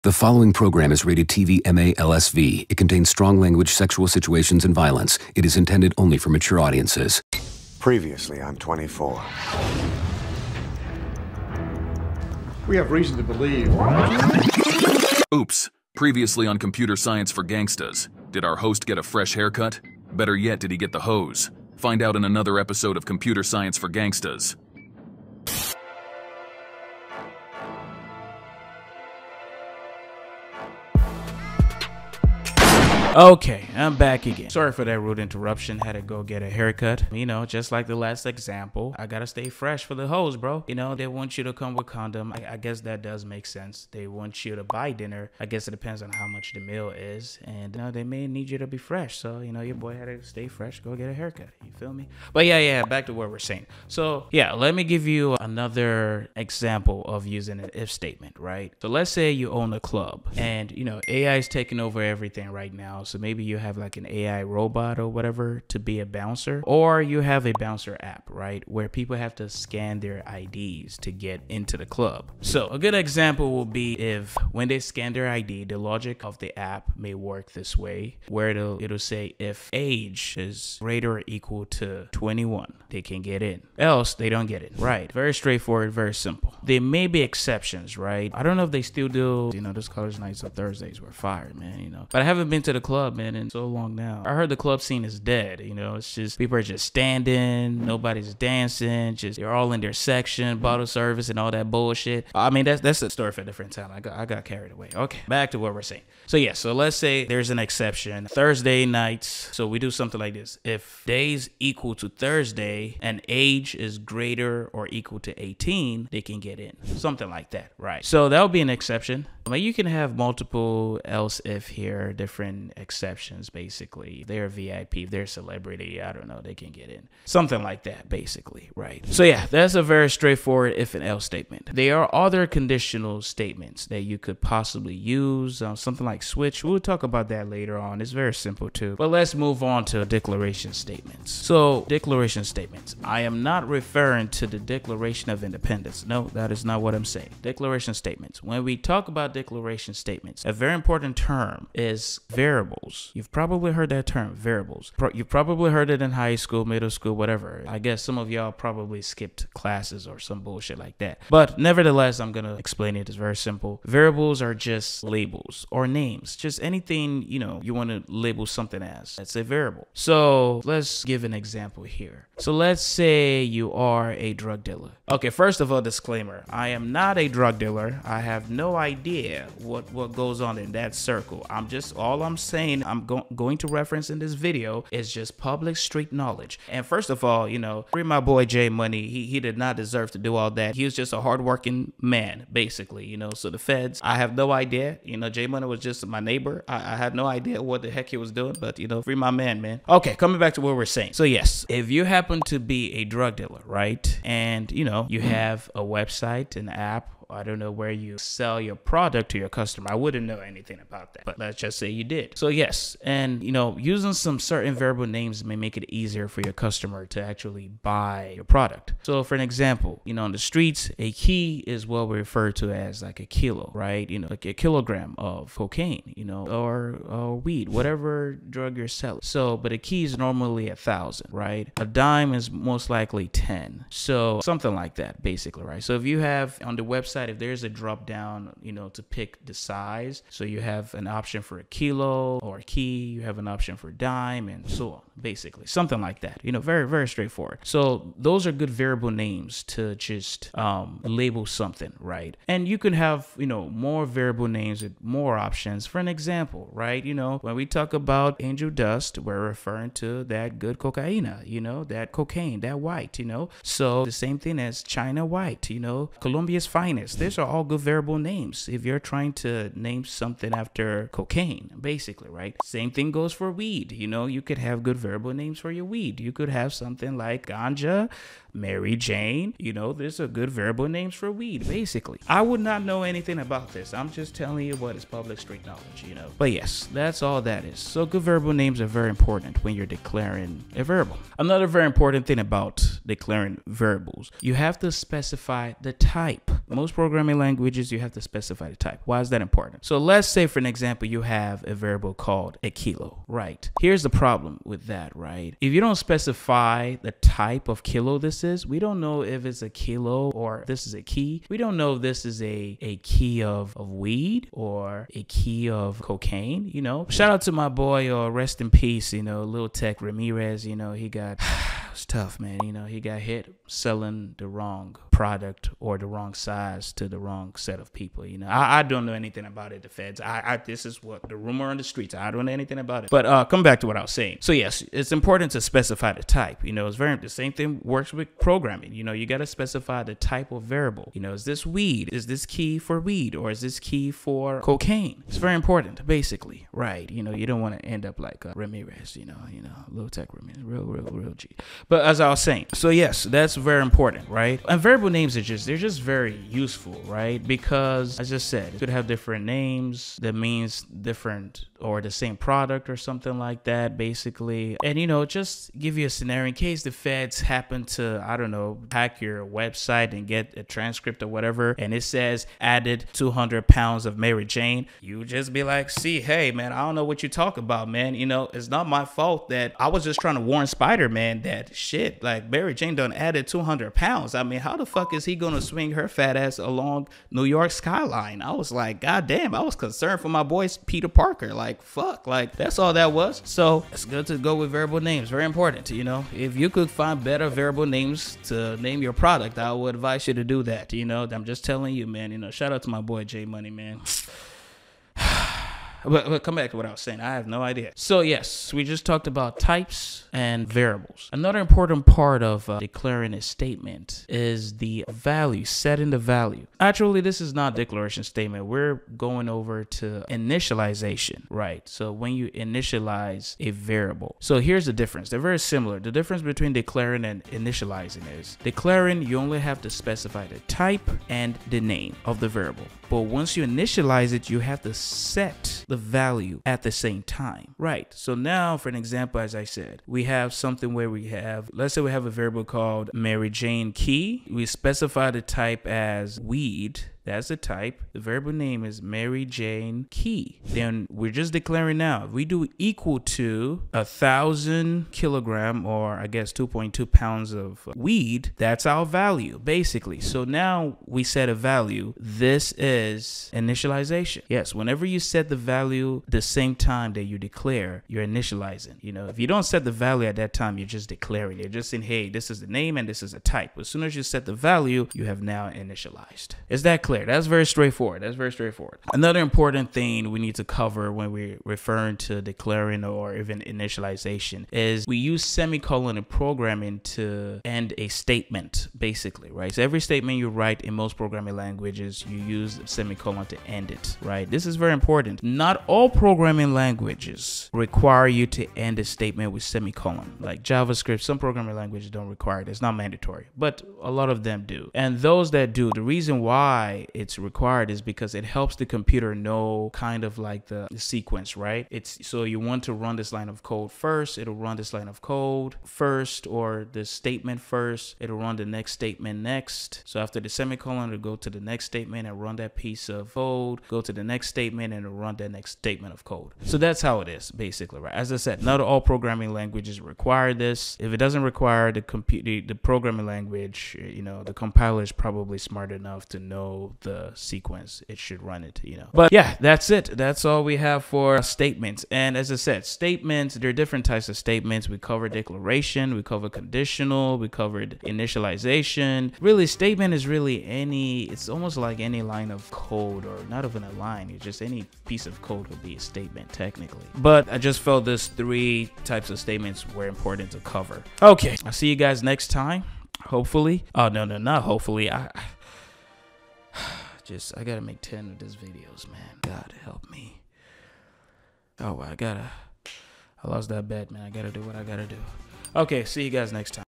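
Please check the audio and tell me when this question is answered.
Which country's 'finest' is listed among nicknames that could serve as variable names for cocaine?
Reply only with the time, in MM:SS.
04:26.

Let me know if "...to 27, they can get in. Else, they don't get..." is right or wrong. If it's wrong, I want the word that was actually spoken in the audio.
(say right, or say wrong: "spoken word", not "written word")
wrong: "21", not "27".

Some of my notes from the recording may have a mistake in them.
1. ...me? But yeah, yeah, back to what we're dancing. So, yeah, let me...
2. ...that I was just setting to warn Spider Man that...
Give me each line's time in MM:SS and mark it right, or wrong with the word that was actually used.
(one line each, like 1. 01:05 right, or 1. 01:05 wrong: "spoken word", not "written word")
1. 00:51 wrong: "saying", not "dancing"
2. 06:19 wrong: "trying", not "setting".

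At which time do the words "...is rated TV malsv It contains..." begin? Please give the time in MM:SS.
00:00.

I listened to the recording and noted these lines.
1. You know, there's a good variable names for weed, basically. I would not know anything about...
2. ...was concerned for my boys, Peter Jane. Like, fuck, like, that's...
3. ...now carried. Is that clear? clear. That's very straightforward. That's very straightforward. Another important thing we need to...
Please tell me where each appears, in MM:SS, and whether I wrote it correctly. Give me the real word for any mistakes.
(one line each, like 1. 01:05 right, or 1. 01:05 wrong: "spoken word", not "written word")
1. 04:39 right
2. 06:29 wrong: "Parker", not "Jane"
3. 07:55 wrong: "initialized", not "carried".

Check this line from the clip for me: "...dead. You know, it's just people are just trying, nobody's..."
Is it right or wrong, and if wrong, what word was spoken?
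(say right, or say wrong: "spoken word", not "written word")
wrong: "standing", not "trying".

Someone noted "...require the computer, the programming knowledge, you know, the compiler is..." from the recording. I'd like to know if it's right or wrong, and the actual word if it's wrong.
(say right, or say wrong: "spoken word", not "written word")
wrong: "language", not "knowledge".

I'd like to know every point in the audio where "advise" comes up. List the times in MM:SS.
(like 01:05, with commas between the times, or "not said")
06:39.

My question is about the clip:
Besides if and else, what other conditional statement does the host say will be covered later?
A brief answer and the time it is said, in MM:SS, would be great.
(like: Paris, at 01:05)
switch, at 02:16.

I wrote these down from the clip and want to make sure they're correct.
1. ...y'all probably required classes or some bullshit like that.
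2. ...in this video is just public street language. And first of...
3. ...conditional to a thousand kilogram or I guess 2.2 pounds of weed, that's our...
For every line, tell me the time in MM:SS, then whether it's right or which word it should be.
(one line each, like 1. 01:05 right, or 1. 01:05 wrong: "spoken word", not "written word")
1. 02:38 wrong: "skipped", not "required"
2. 03:04 wrong: "knowledge", not "language"
3. 07:32 wrong: "equal", not "conditional".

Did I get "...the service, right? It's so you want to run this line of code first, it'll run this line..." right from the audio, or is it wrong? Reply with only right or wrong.
wrong.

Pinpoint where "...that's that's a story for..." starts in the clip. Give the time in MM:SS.
01:42.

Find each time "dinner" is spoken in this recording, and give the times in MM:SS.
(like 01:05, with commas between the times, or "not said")
00:44.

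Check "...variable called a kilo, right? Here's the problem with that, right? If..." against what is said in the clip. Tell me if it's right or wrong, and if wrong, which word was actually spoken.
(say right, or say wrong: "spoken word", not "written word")
right.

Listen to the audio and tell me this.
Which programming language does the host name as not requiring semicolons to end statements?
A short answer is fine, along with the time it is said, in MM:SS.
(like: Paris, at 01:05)
JavaScript, at 08:20.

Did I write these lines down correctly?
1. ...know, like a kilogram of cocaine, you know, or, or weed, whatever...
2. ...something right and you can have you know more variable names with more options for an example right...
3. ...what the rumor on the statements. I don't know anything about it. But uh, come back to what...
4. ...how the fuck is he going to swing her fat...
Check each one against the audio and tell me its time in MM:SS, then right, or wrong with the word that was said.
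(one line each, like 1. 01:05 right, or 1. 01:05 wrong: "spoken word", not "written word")
1. 03:44 right
2. 04:11 right
3. 05:31 wrong: "streets", not "statements"
4. 06:24 right.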